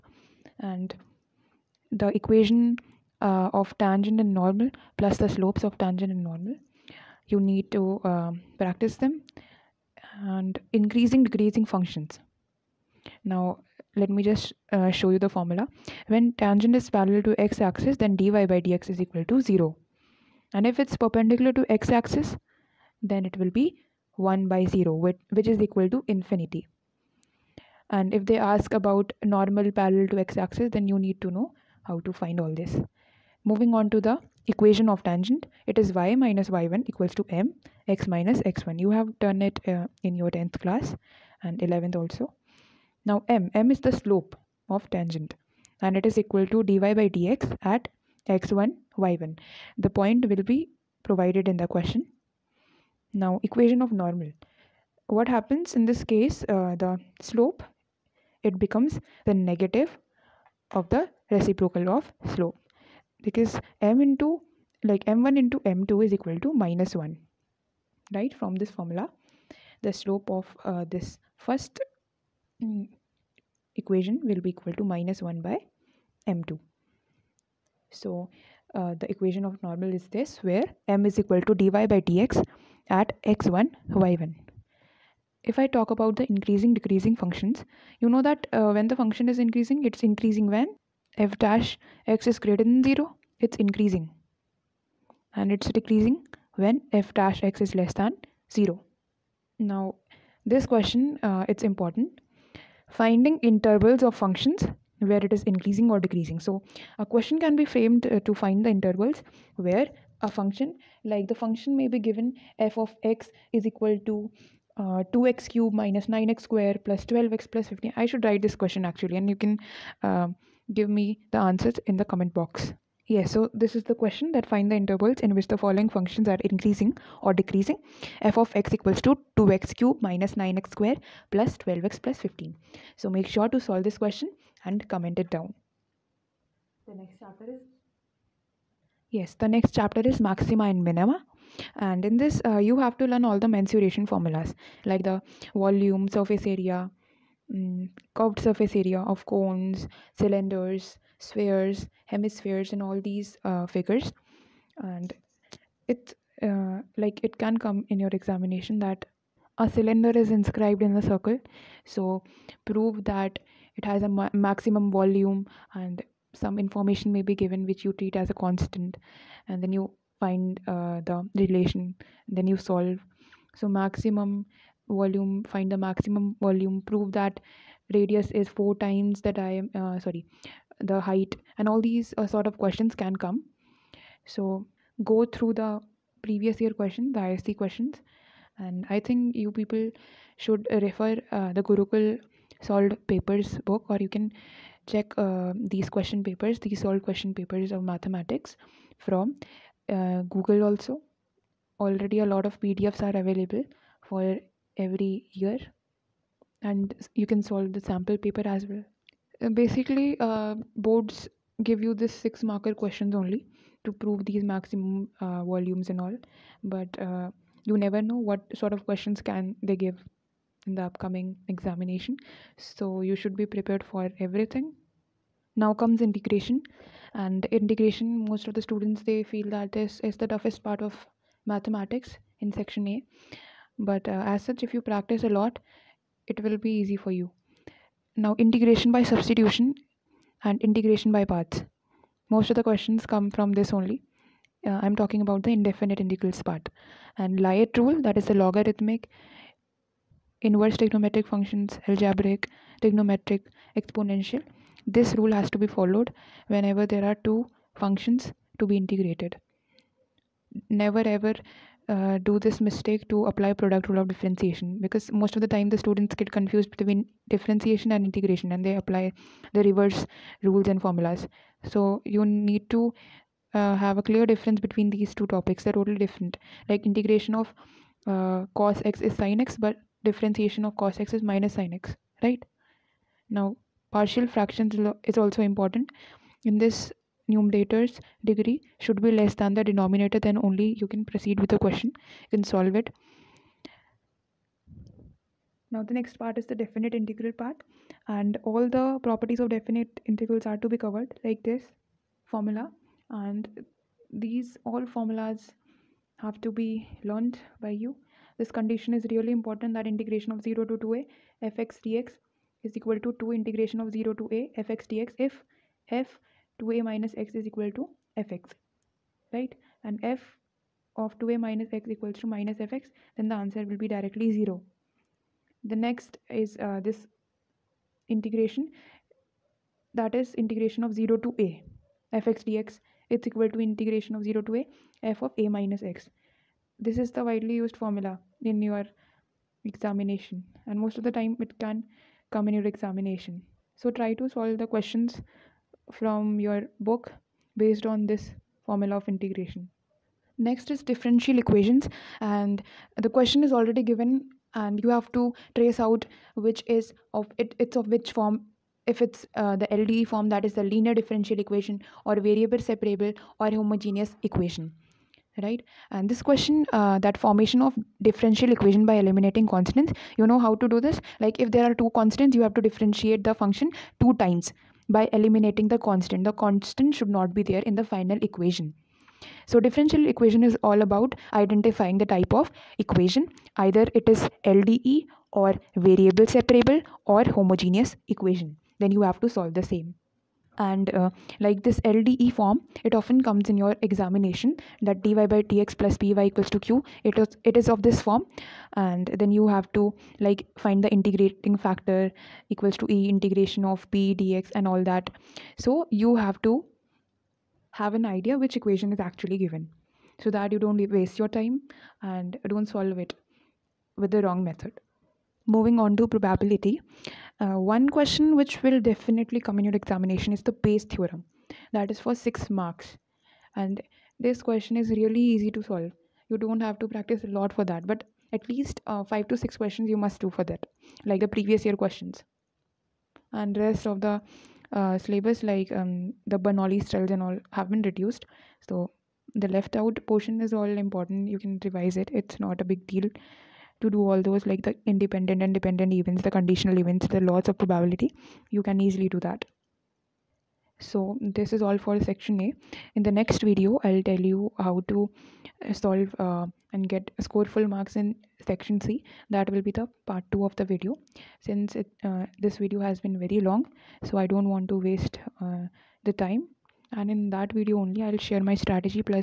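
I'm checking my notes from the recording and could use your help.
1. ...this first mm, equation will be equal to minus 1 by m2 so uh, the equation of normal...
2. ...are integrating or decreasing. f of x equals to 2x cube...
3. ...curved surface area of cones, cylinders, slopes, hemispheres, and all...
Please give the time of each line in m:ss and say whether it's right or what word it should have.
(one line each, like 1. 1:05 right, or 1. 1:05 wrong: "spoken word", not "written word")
1. 1:10 right
2. 2:06 wrong: "increasing", not "integrating"
3. 2:28 wrong: "spheres", not "slopes".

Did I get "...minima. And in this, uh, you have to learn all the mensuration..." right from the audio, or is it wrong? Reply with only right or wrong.
right.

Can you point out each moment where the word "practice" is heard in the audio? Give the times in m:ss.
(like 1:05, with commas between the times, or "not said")
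0:08, 3:54, 7:06.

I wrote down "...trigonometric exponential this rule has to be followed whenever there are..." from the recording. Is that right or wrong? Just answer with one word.
right.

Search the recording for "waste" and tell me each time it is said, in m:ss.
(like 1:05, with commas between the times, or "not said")
6:50, 7:44.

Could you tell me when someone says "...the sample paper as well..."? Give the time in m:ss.
3:27.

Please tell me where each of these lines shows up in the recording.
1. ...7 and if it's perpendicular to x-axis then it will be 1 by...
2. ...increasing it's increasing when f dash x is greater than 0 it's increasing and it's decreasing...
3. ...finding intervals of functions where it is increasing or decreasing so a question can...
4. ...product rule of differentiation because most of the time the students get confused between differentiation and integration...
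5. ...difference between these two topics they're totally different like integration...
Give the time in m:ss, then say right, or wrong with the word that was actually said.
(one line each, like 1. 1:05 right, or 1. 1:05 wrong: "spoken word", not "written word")
1. 0:19 wrong: "0", not "7"
2. 1:29 right
3. 1:42 right
4. 4:23 right
5. 4:34 right.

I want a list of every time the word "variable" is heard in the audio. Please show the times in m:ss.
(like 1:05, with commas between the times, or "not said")
6:02, 6:25.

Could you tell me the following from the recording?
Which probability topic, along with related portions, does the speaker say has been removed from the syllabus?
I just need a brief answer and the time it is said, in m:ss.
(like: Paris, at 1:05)
Bernoulli trials, at 7:16.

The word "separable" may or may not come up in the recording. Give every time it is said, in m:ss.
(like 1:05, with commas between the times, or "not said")
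6:02, 6:26.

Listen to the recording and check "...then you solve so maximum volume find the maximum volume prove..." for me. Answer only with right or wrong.
right.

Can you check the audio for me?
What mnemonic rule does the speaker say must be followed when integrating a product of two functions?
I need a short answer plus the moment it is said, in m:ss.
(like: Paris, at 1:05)
LIATE rule, at 4:07.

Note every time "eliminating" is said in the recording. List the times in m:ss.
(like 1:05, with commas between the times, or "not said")
6:08, 6:15.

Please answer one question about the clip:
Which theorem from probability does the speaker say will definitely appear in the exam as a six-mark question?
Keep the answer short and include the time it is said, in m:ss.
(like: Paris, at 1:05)
Bayes theorem, at 7:00.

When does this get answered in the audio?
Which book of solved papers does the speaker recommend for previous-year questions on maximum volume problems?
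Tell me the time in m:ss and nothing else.
3:11.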